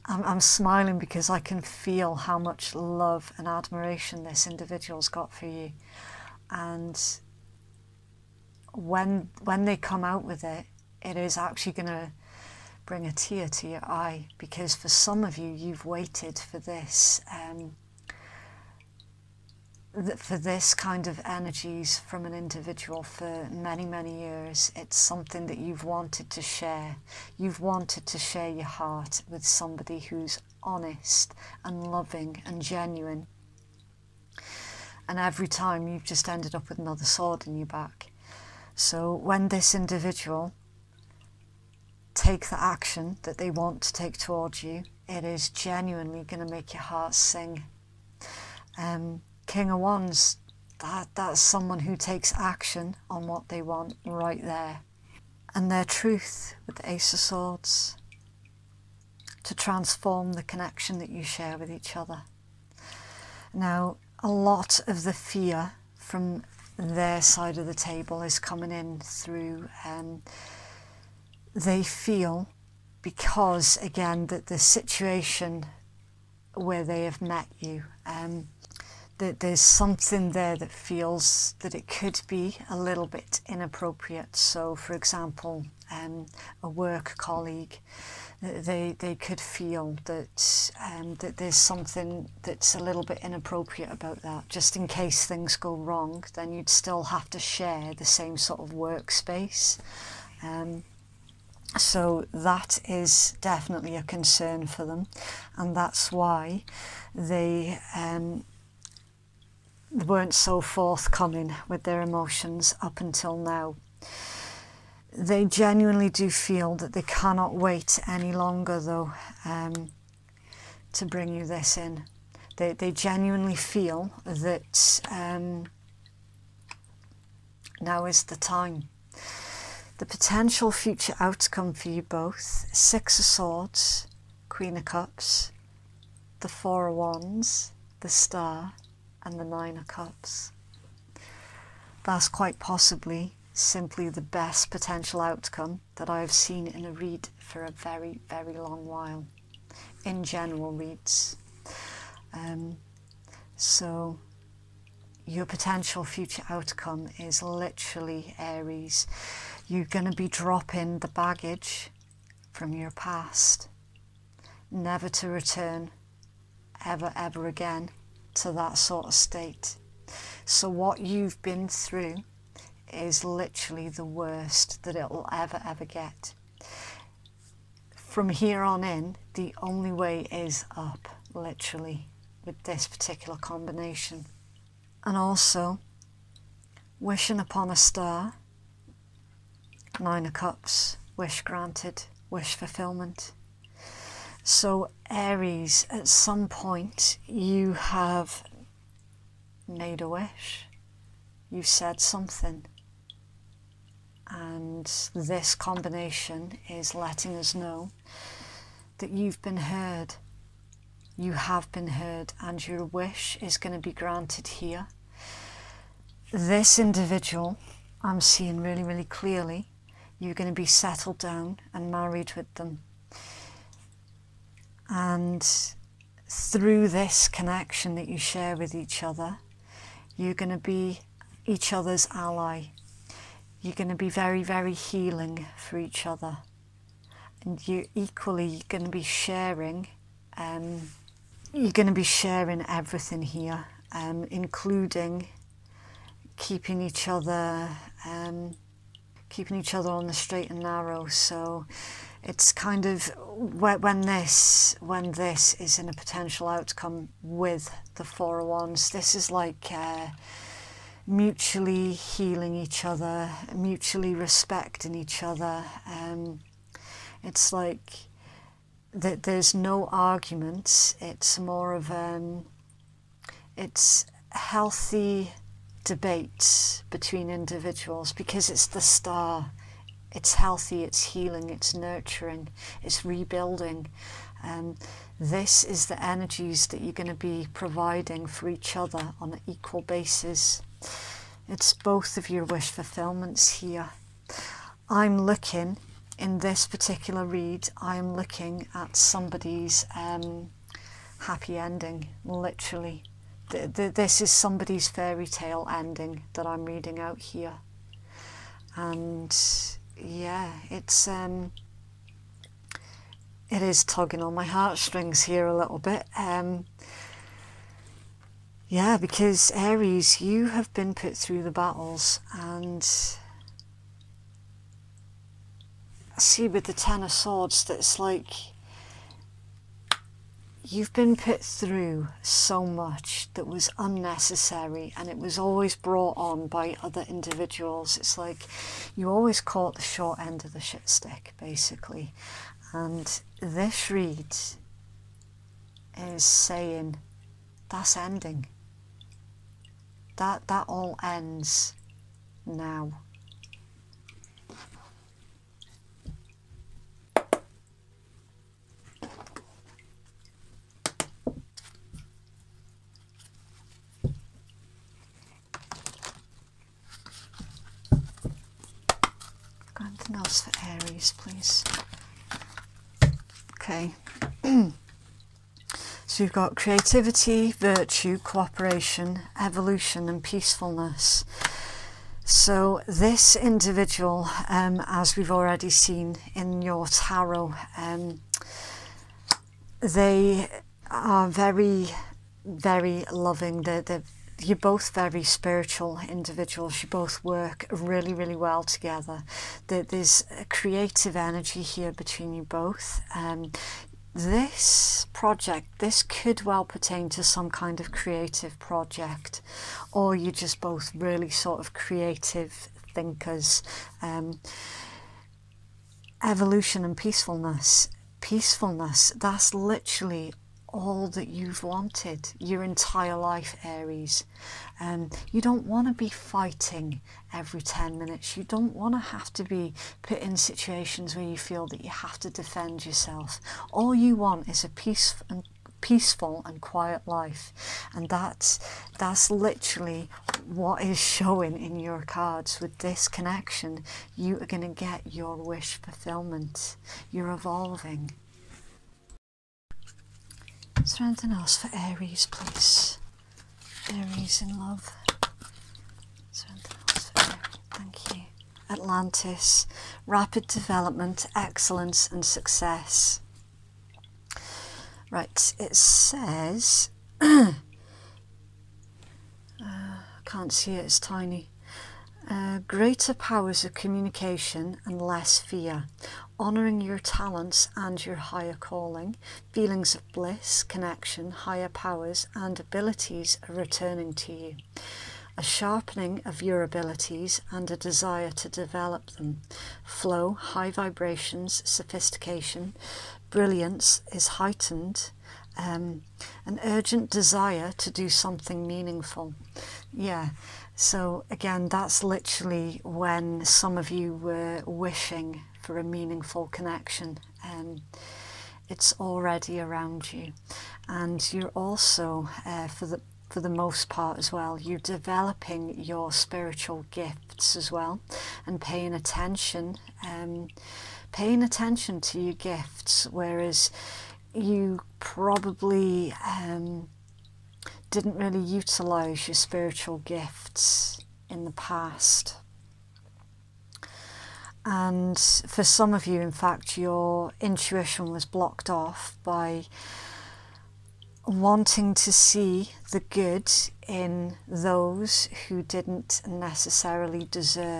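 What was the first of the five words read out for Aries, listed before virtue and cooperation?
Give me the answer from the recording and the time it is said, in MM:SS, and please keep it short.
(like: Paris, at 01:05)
Creativity, at 06:16.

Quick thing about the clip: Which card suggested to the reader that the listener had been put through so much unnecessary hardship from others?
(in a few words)
Ten of Swords.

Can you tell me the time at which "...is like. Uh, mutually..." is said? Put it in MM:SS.
04:19.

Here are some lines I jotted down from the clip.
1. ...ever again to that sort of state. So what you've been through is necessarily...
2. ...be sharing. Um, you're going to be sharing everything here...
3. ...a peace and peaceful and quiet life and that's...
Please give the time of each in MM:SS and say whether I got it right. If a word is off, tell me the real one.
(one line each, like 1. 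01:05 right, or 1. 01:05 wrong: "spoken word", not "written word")
1. 02:47 wrong: "literally", not "necessarily"
2. 03:58 right
3. 07:14 right.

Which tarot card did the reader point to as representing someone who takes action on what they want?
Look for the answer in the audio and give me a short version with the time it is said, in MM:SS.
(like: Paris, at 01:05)
King of Wands, at 00:49.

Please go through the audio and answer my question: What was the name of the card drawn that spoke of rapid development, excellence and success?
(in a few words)
Atlantis.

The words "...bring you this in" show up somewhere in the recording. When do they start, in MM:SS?
02:01.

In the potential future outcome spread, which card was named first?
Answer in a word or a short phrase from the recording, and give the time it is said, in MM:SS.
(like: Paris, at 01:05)
Six of Swords, at 02:12.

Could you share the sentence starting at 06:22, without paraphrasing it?
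So, this individual, um, as we've already seen in your tarot, um, they are very, very loving.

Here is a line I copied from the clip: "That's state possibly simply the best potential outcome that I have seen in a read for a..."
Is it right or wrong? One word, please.
wrong.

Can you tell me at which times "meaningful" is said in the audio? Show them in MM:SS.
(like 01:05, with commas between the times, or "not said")
08:18, 08:25.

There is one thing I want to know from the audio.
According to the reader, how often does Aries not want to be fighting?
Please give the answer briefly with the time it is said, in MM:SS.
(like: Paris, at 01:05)
Every 10 minutes, at 07:07.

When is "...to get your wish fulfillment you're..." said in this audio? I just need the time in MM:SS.
07:24.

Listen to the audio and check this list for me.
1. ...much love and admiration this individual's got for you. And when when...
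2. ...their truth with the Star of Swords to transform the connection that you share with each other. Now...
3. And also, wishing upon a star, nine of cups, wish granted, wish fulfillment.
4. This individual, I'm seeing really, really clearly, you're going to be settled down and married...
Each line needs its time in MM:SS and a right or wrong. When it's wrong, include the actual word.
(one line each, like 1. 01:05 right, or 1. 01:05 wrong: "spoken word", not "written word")
1. 00:02 right
2. 00:55 wrong: "Ace", not "Star"
3. 03:05 right
4. 03:36 right.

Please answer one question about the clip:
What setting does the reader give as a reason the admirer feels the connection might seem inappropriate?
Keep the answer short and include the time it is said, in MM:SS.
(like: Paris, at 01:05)
A work colleague, at 01:26.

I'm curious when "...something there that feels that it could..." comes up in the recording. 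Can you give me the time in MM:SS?
01:19.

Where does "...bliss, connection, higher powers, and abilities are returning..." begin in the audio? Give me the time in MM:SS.
08:00.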